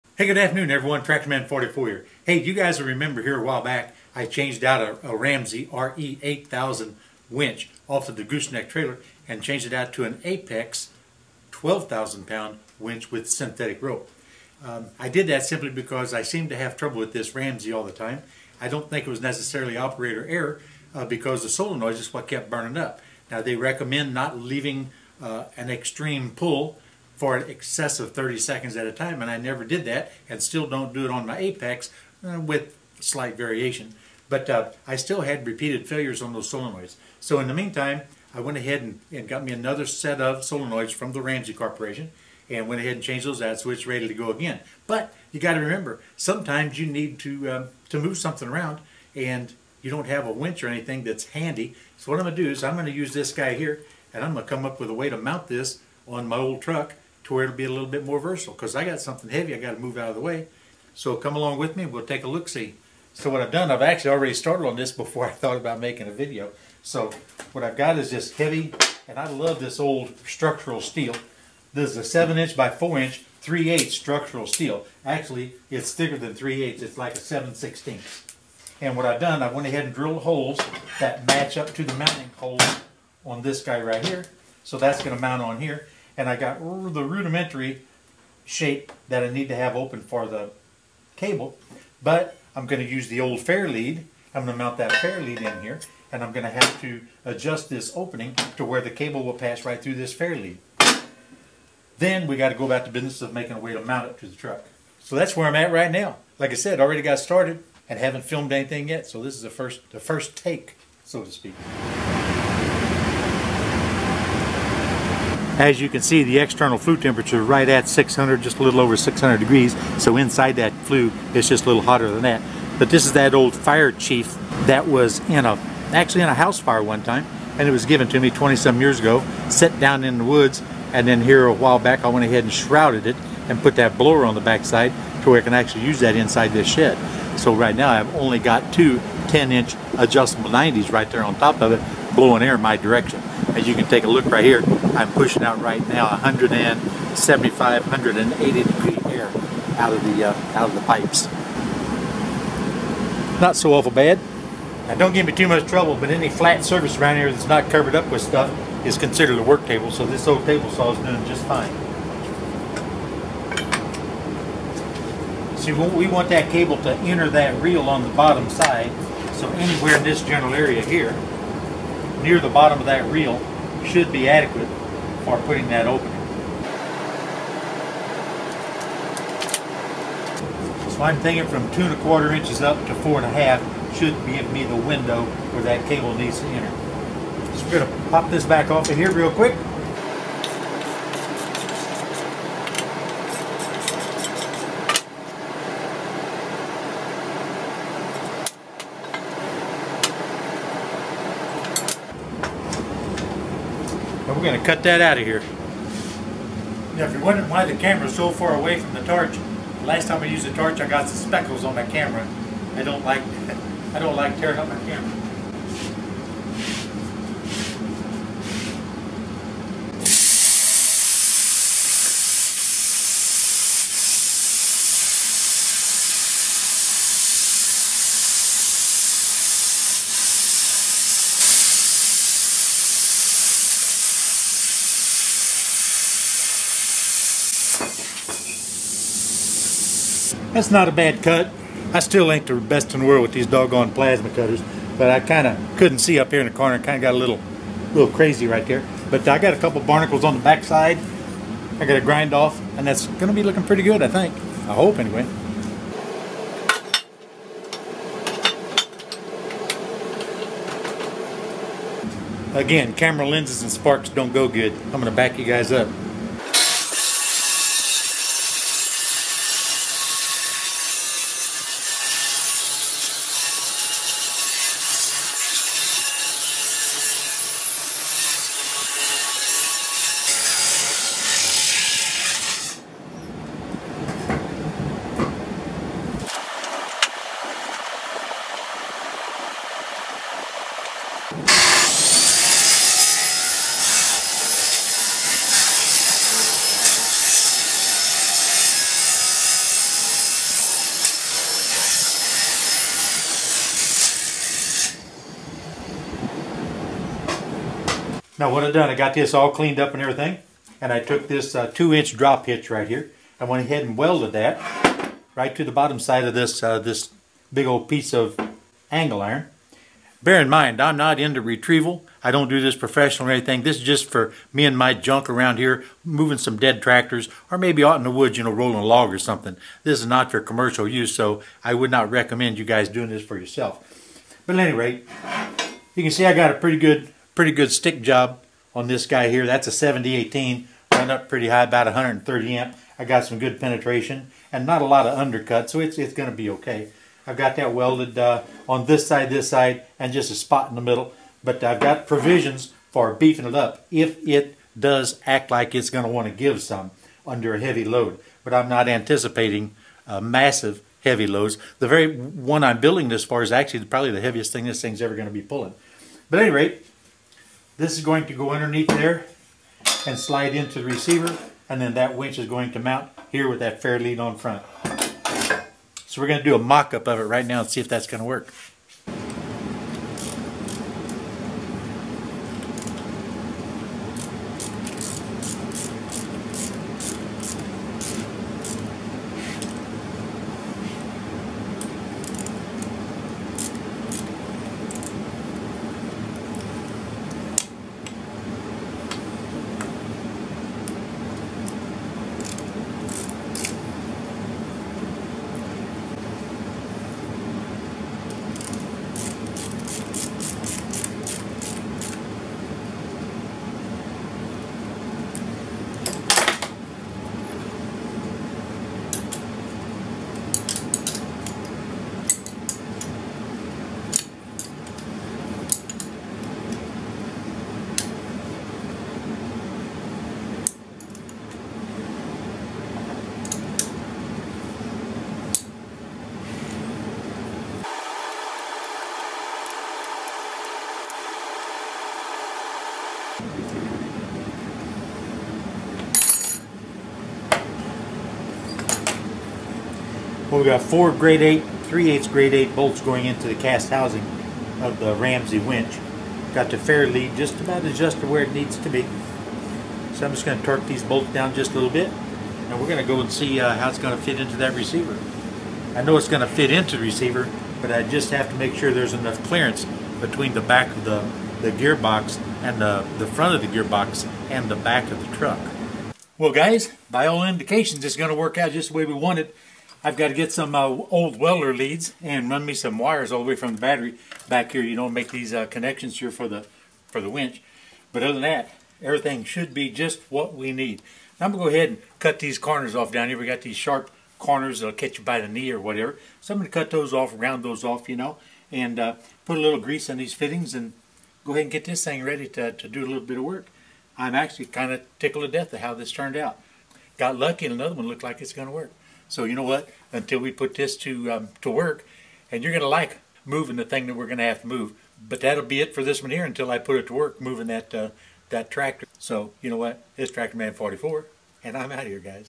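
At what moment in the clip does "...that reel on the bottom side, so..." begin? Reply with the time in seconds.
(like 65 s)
167 s.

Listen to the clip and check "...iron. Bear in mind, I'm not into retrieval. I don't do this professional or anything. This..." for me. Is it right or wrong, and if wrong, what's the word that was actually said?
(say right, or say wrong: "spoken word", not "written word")
right.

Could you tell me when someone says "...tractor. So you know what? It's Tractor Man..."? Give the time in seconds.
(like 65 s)
518 s.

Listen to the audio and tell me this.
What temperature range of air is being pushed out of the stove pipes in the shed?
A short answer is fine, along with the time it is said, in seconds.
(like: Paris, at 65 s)
175 to 180 degrees, at 146 s.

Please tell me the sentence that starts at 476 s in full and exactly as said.
Well guys, by all indications it's going to work out just the way we want it.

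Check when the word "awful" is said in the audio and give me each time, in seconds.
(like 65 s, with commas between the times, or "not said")
153 s.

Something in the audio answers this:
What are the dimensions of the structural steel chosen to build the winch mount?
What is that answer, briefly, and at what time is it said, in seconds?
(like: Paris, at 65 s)
7 inch by 4 inch, at 72 s.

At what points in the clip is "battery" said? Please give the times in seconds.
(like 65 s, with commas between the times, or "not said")
483 s.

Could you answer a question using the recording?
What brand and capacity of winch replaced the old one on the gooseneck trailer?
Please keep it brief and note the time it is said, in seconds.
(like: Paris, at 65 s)
Apex 12,000 pound, at 10 s.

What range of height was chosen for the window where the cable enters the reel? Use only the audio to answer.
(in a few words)
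2.25 to 4.5 inches.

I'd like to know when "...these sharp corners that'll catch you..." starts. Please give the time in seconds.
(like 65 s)
493 s.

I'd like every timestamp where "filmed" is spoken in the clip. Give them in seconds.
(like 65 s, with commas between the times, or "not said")
108 s.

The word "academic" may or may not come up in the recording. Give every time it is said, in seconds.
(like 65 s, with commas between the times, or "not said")
not said.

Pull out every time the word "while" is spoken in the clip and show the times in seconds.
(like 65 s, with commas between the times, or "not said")
3 s, 131 s.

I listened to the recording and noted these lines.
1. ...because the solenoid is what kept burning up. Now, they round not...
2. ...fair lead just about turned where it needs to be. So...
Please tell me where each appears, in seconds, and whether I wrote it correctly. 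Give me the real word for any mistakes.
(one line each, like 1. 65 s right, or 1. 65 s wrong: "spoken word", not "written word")
1. 21 s wrong: "recommend", not "round"
2. 456 s wrong: "adjusted", not "turned".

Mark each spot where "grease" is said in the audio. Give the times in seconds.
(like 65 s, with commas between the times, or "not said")
499 s.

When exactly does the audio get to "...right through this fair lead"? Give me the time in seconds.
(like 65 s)
99 s.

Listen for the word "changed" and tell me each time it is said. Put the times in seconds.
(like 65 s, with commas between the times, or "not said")
4 s, 9 s, 43 s.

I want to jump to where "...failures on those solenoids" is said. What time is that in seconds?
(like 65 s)
35 s.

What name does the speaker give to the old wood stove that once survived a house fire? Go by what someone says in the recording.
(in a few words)
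fire chief.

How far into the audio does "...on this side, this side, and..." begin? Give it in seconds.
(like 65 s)
348 s.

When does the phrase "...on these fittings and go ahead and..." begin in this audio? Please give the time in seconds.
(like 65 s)
500 s.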